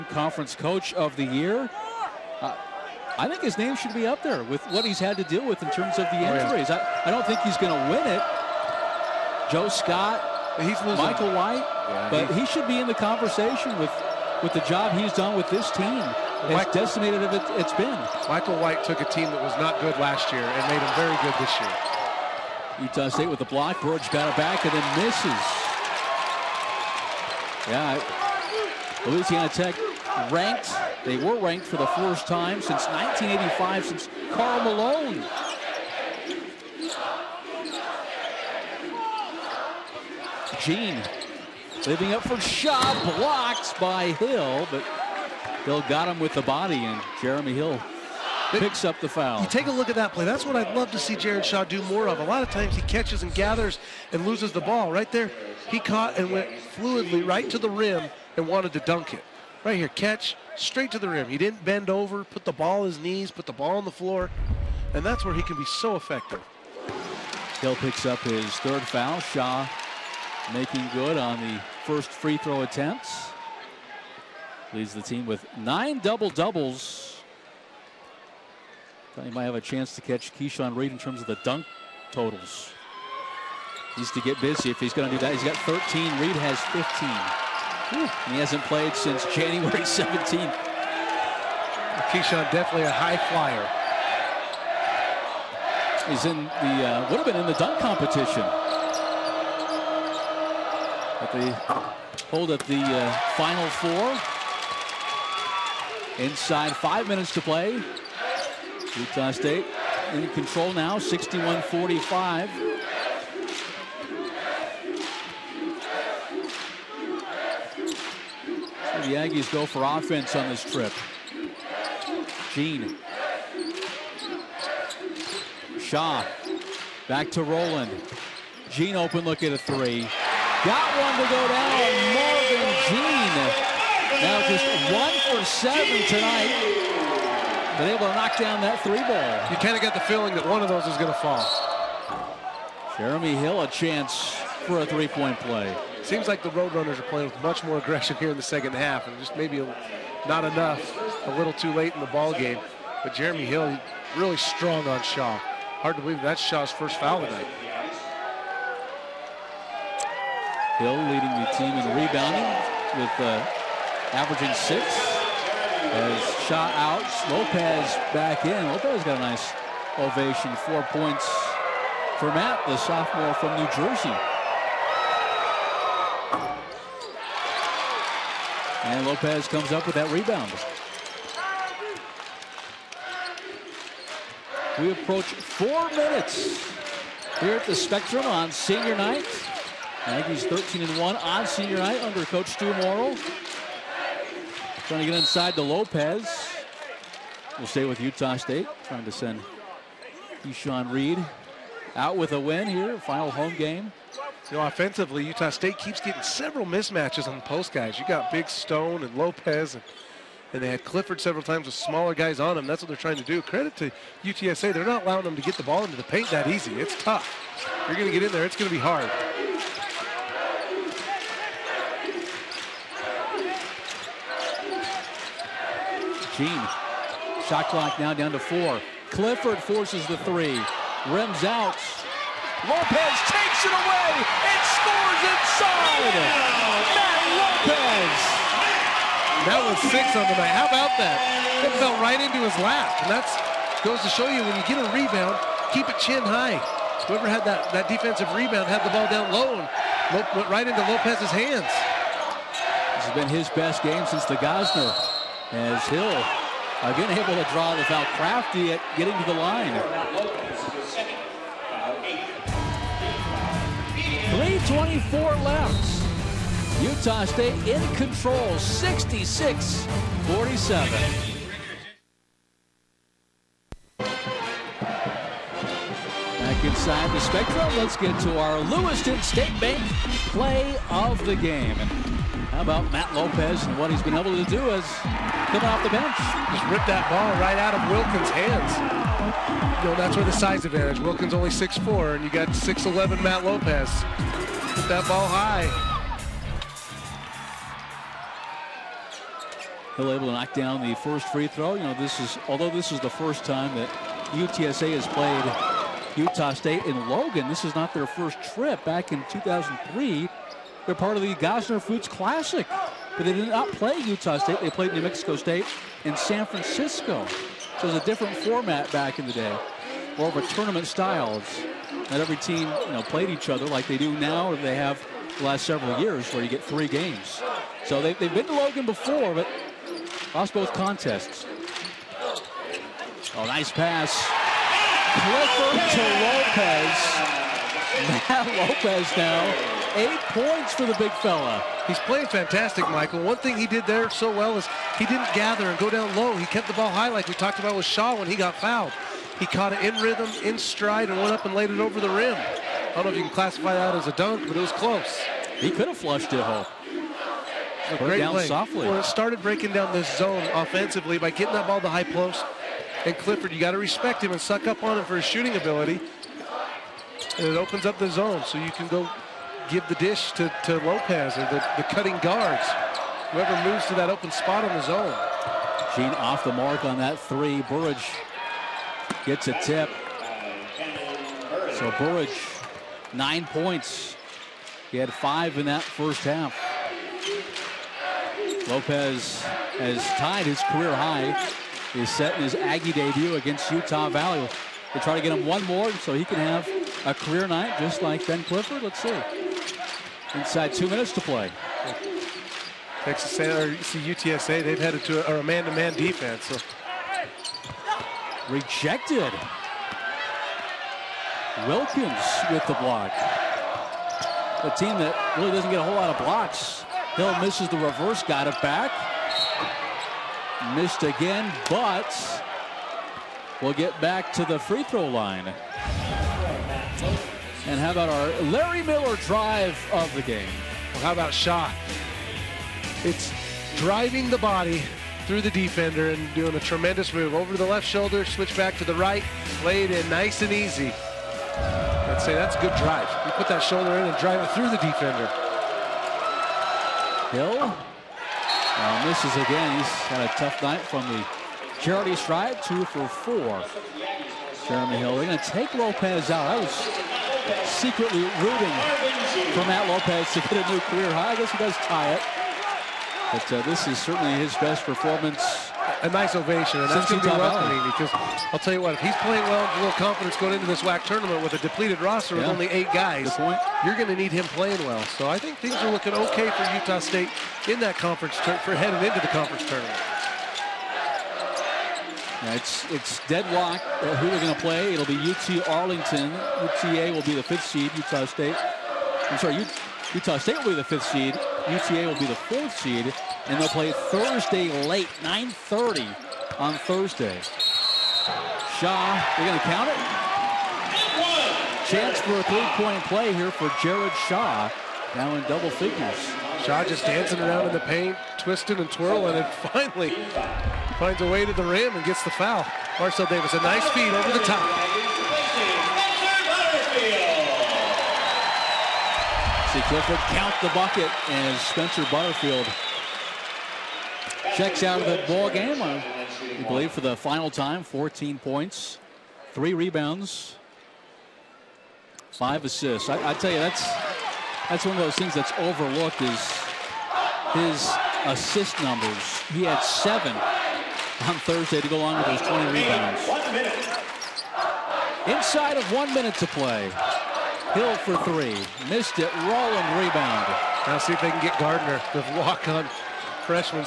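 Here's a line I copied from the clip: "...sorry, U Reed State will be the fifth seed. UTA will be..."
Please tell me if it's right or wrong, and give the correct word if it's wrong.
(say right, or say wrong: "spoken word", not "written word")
wrong: "Utah", not "Reed".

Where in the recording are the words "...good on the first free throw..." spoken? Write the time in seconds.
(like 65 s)
70 s.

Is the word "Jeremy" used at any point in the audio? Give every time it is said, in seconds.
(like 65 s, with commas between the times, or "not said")
47 s, 142 s, 153 s.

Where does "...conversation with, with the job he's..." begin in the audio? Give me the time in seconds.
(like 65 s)
12 s.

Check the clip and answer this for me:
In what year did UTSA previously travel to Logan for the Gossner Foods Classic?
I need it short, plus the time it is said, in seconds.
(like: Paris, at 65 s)
2003, at 309 s.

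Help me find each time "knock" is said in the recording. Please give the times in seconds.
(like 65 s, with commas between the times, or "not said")
138 s, 300 s.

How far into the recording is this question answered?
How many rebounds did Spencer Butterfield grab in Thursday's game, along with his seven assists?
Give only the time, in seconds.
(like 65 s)
542 s.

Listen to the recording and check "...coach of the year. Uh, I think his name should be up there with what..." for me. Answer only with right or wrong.
right.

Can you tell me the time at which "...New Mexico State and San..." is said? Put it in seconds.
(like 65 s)
314 s.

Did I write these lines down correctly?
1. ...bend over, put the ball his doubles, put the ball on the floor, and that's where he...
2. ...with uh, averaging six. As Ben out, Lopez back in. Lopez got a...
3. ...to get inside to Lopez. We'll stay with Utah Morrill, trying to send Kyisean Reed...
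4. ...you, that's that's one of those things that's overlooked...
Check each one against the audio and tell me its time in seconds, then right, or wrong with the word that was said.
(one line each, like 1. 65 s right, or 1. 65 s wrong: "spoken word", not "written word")
1. 61 s wrong: "knees", not "doubles"
2. 162 s wrong: "Shaw", not "Ben"
3. 194 s wrong: "State", not "Morrill"
4. 533 s right.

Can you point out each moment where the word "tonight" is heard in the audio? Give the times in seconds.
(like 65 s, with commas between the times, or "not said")
136 s, 157 s.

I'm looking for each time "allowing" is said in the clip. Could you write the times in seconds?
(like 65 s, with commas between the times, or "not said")
215 s.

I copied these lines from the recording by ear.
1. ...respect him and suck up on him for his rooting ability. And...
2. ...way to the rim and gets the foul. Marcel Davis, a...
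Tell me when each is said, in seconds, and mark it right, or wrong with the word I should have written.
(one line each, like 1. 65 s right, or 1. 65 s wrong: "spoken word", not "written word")
1. 363 s wrong: "shooting", not "rooting"
2. 511 s right.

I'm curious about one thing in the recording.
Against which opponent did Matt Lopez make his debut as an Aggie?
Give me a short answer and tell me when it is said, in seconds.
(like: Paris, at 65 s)
Utah Valley, at 393 s.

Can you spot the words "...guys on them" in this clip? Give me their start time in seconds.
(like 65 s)
212 s.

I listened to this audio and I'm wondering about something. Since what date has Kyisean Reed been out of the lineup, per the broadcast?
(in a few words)
January 17th.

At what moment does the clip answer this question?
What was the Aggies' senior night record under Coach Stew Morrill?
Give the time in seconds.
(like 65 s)
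190 s.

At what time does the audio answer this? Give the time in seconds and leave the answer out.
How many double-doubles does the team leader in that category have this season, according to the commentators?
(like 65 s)
75 s.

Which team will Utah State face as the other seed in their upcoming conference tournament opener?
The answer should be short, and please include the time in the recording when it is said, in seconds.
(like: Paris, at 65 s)
UT Arlington, at 485 s.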